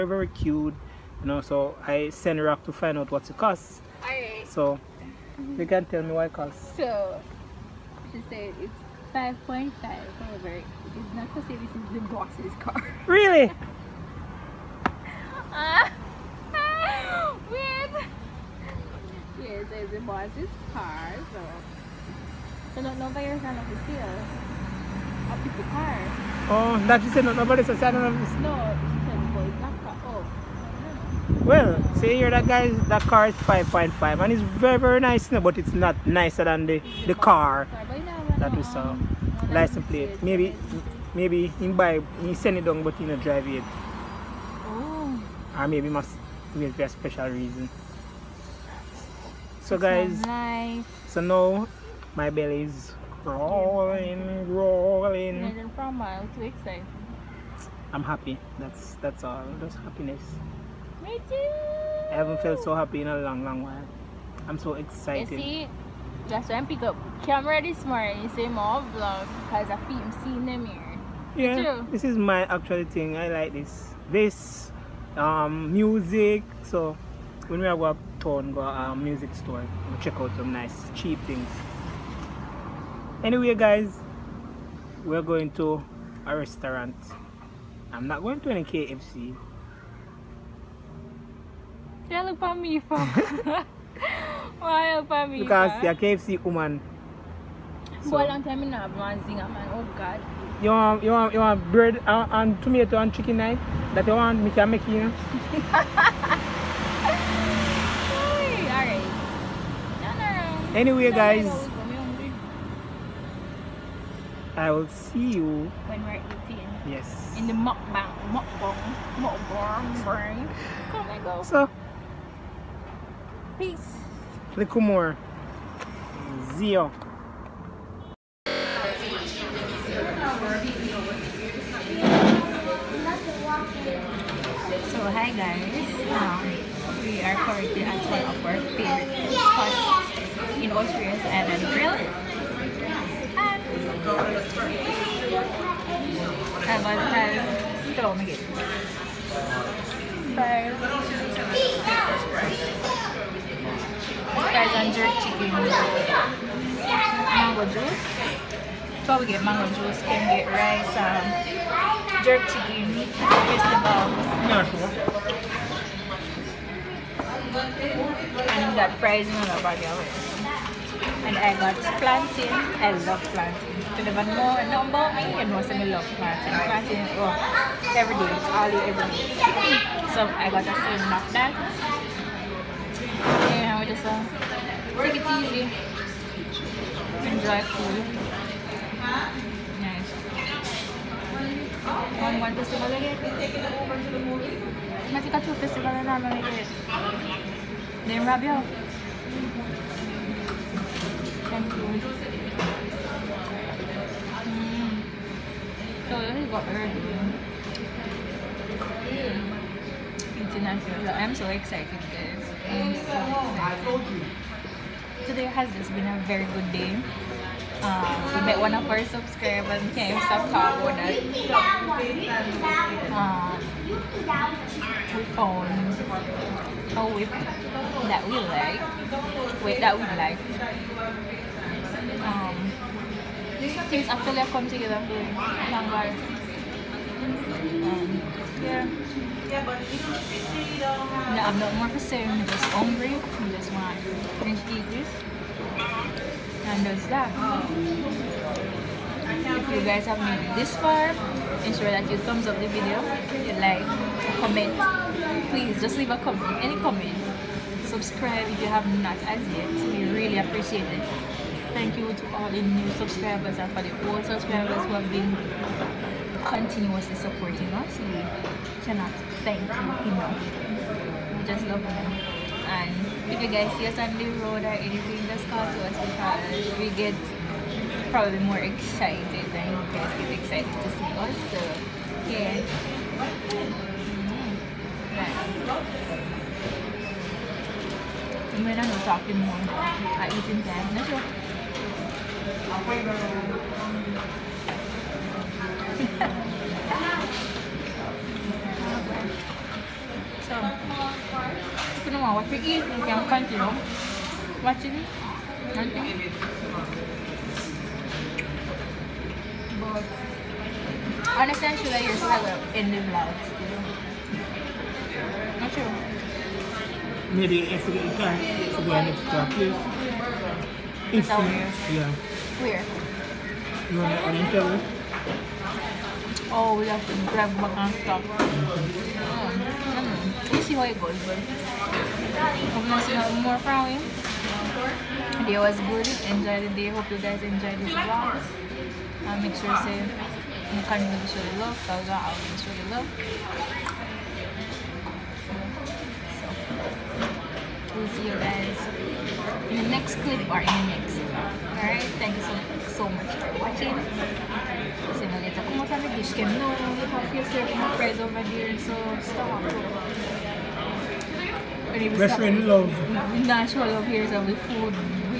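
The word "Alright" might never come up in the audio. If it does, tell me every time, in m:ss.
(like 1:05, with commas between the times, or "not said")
5:51.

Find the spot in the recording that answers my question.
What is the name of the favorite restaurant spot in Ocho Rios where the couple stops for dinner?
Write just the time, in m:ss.
2:21.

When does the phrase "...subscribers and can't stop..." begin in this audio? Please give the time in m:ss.
3:39.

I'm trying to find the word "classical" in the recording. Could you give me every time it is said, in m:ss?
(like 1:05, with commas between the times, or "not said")
not said.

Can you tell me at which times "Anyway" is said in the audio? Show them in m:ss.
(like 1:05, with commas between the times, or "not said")
1:23, 1:50.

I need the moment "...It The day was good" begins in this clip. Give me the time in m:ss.
5:33.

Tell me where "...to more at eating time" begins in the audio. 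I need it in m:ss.
4:49.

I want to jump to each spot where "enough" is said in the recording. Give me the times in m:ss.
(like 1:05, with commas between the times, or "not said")
4:29.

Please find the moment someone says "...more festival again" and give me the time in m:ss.
3:12.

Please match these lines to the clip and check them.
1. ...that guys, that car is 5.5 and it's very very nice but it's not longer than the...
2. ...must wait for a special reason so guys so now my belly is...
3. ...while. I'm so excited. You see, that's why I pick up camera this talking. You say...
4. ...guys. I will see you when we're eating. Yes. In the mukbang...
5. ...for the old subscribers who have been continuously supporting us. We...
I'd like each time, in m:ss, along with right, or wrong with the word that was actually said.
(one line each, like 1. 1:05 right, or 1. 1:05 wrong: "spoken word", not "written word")
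1. 0:32 wrong: "nicer", not "longer"
2. 0:45 right
3. 1:03 wrong: "morning", not "talking"
4. 1:51 right
5. 4:23 right.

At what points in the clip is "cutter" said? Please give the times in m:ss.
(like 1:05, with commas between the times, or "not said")
not said.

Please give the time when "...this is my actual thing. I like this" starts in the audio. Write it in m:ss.
1:11.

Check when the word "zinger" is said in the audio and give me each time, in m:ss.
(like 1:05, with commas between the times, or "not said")
1:39.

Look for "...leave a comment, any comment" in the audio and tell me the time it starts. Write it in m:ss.
4:15.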